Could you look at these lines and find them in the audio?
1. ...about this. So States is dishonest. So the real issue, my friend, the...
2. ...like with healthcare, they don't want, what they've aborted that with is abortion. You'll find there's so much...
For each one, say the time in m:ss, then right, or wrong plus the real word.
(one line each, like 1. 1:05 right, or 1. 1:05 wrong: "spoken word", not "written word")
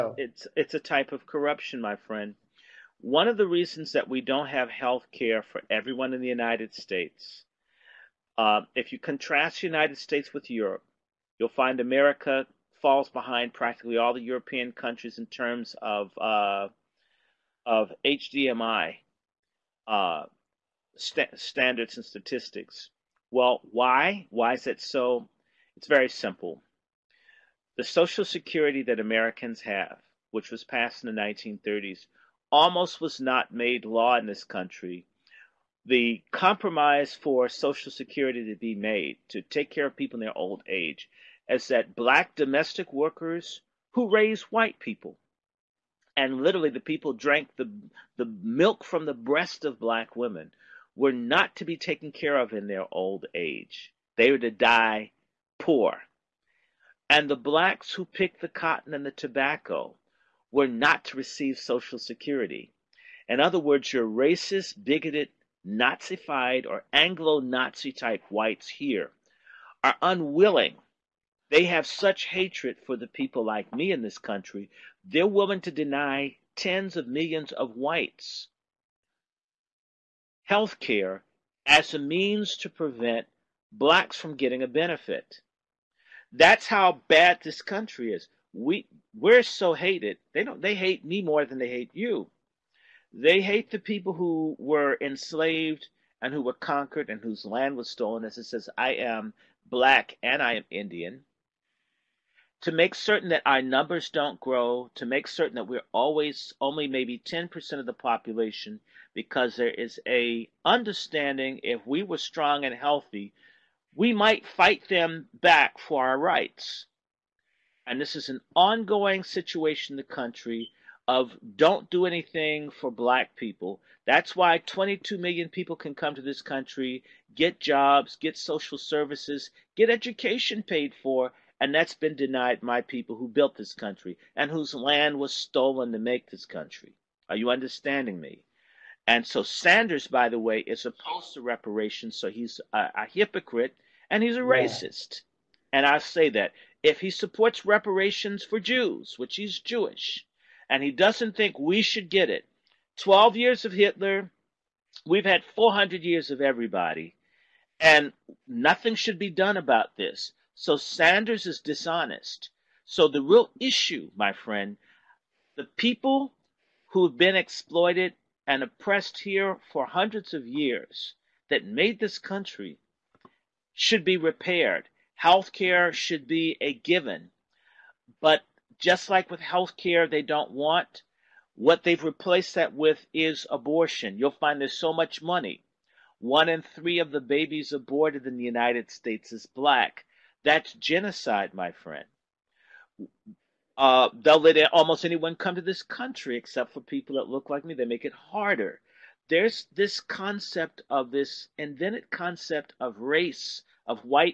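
1. 2:39 wrong: "Sanders", not "States"
2. 2:59 wrong: "replaced", not "aborted".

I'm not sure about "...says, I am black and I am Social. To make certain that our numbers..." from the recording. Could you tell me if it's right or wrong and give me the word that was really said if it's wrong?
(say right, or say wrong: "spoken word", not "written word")
wrong: "Indian", not "Social".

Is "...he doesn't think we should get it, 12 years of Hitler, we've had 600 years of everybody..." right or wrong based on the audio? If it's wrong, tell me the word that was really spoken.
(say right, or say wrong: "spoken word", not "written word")
wrong: "400", not "600".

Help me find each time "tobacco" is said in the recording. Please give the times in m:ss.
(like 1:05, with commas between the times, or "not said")
0:59.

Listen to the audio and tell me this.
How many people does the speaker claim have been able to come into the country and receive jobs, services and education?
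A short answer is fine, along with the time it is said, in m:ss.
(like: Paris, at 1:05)
22 million, at 2:04.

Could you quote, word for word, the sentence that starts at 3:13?
Uh, they'll let almost anyone come to this country except for people that look like me.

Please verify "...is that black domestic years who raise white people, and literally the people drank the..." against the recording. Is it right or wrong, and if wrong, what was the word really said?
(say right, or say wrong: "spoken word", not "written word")
wrong: "workers", not "years".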